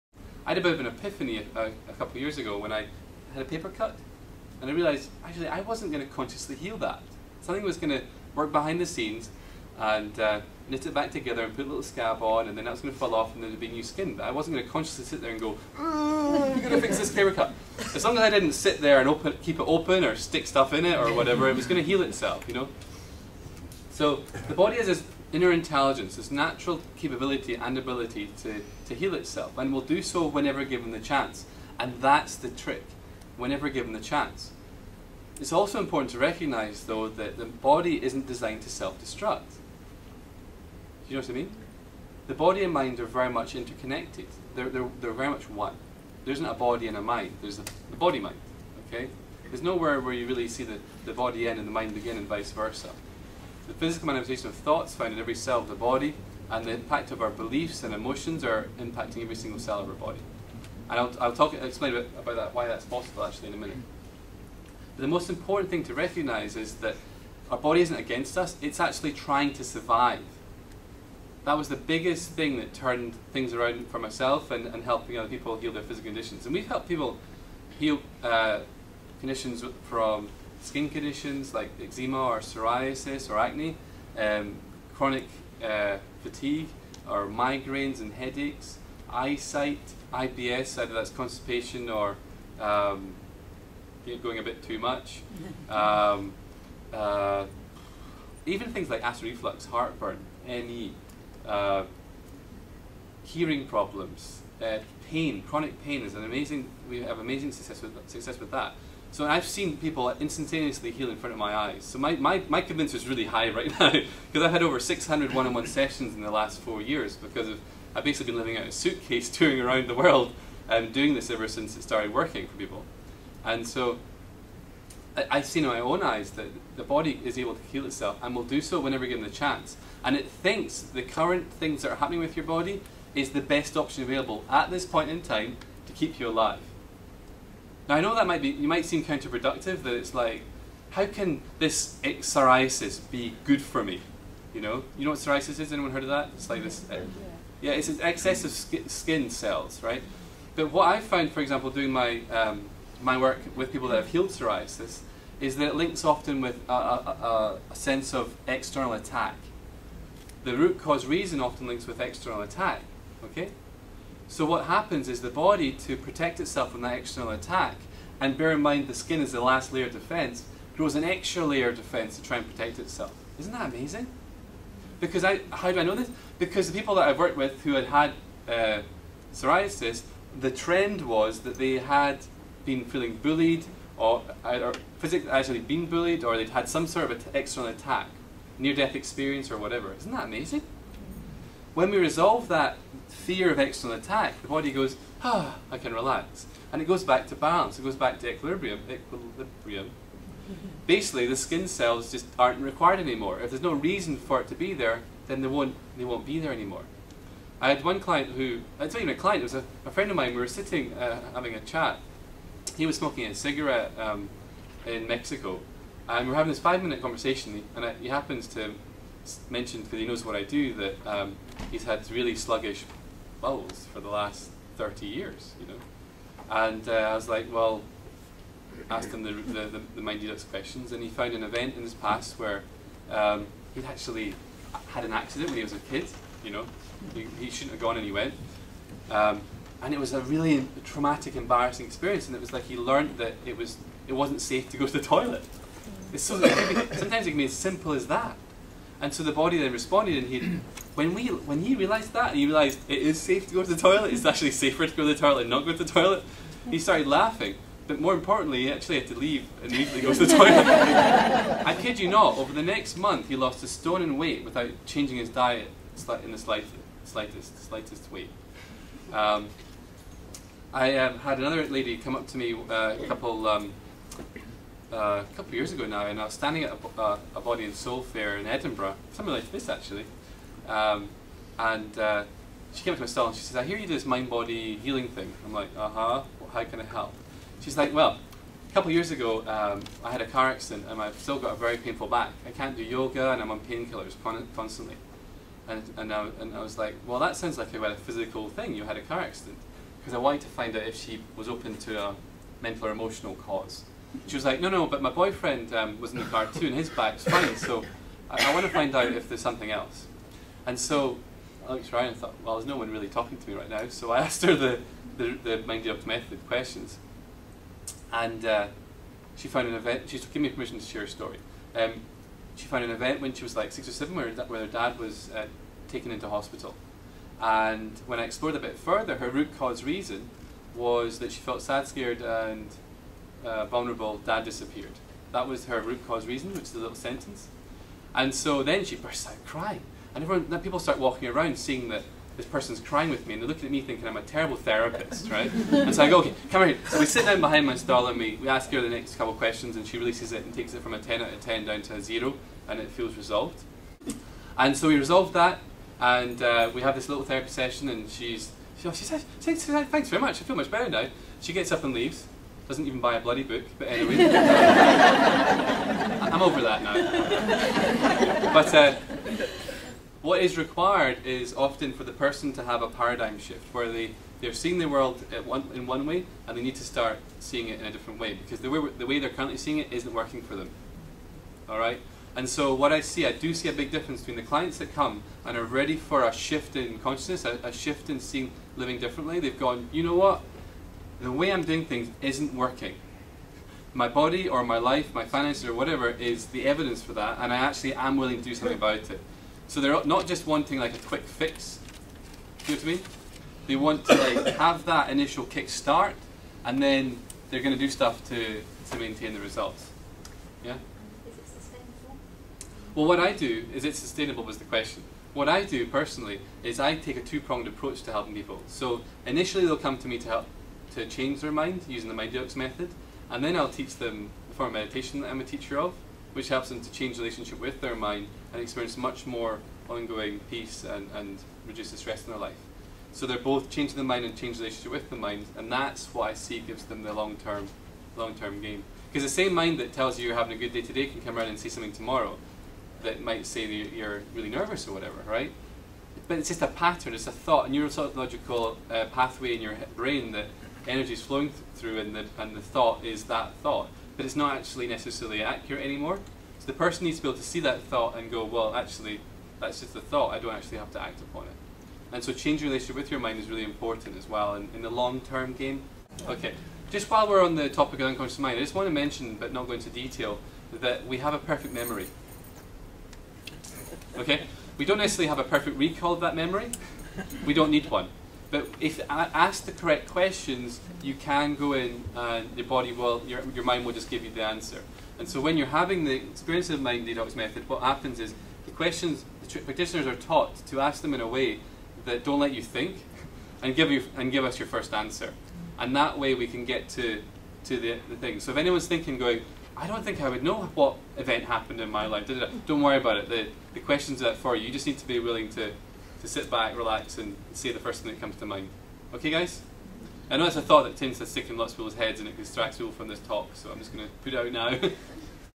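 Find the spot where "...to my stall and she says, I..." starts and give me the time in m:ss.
4:42.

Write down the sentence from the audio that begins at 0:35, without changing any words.
It's also important to recognize, though, that the body isn't designed to self destruct.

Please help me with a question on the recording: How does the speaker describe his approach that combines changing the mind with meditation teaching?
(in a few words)
two-pronged.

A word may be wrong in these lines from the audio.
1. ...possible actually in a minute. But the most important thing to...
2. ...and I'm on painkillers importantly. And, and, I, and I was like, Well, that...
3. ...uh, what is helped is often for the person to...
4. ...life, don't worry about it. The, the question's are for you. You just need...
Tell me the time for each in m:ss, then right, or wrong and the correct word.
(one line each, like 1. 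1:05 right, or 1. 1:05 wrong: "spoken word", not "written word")
1. 1:02 right
2. 4:53 wrong: "constantly", not "importantly"
3. 6:08 wrong: "required", not "helped"
4. 8:22 right.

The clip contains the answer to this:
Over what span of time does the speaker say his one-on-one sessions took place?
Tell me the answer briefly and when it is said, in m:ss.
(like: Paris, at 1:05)
4 years, at 1:56.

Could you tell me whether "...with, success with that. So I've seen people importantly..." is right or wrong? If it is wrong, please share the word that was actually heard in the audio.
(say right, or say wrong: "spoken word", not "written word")
wrong: "instantaneously", not "importantly".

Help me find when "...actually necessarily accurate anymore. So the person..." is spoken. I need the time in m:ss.
7:34.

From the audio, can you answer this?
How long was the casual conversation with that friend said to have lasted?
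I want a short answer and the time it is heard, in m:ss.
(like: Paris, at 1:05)
5 minutes, at 3:36.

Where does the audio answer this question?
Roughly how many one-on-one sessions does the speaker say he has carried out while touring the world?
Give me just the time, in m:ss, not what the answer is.
1:54.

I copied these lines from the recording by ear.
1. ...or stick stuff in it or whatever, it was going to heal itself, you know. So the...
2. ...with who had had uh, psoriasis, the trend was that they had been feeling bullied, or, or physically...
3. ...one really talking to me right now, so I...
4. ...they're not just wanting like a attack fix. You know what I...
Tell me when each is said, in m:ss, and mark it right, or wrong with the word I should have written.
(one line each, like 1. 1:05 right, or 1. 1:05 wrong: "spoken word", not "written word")
1. 0:20 right
2. 2:57 right
3. 5:12 right
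4. 6:39 wrong: "quick", not "attack".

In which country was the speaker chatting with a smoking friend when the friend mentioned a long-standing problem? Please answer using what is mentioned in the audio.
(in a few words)
Mexico.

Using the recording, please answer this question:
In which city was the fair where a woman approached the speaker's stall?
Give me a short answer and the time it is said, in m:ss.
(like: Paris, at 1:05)
Edinburgh, at 4:38.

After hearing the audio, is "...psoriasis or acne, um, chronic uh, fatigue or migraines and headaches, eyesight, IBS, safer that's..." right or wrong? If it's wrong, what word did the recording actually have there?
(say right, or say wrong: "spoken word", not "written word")
wrong: "either", not "safer".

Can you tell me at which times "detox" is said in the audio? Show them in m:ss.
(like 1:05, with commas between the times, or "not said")
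7:02, 8:07.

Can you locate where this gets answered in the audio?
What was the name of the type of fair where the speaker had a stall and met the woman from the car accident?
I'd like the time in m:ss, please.
4:37.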